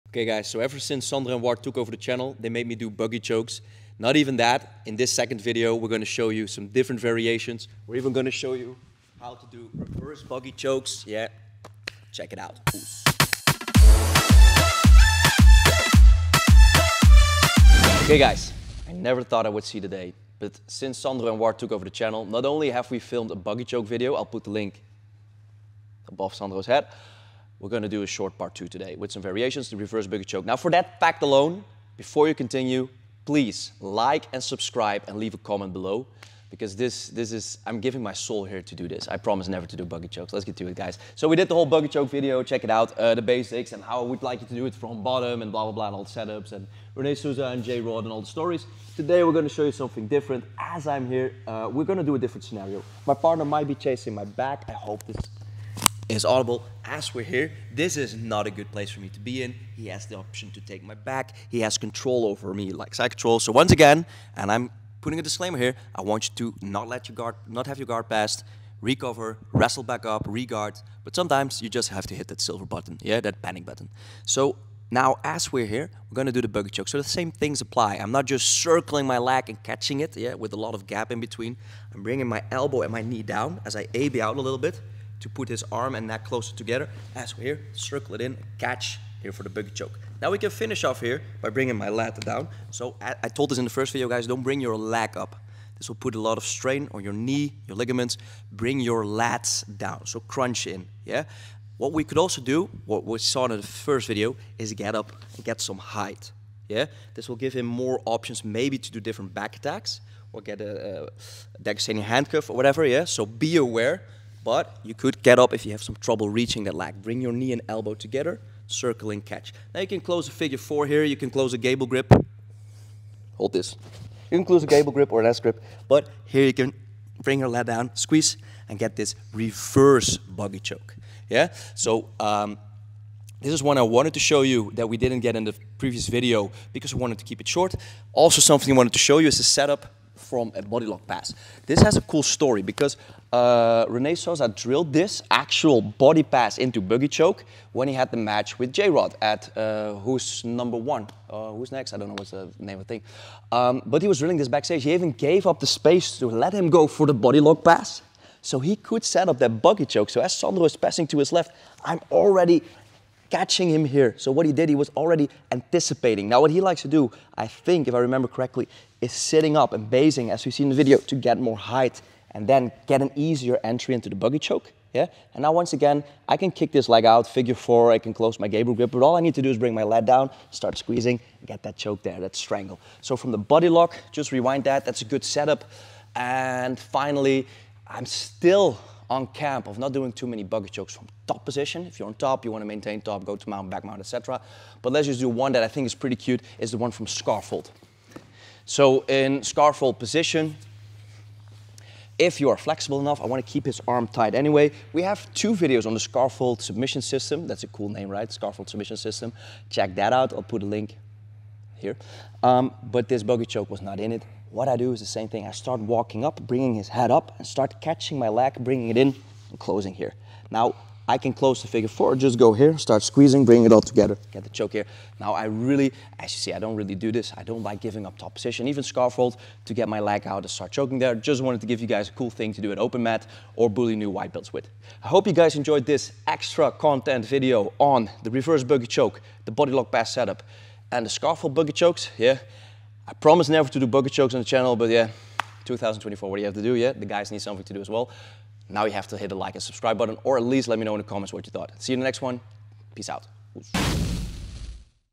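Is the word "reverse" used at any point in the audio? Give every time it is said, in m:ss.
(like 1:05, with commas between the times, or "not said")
0:09, 0:29, 2:09, 3:58.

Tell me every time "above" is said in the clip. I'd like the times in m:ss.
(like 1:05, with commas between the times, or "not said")
0:26.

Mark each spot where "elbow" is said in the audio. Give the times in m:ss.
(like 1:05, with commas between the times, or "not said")
1:22, 1:57.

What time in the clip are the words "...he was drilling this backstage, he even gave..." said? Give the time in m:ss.
2:34.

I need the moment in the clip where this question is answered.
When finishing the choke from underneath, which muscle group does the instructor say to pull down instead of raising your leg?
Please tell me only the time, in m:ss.
1:39.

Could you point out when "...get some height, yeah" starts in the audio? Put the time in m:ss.
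1:45.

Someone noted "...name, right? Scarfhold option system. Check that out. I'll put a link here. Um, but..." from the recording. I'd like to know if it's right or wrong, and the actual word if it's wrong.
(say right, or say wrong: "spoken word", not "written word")
wrong: "submission", not "option".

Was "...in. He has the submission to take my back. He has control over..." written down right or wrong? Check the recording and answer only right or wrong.
wrong.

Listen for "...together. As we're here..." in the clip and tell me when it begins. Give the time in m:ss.
1:26.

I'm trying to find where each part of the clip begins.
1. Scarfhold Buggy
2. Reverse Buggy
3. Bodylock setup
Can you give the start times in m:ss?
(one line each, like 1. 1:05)
1. 3:14
2. 0:40
3. 2:18.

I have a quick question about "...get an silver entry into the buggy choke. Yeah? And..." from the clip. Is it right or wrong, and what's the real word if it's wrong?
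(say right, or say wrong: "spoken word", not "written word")
wrong: "easier", not "silver".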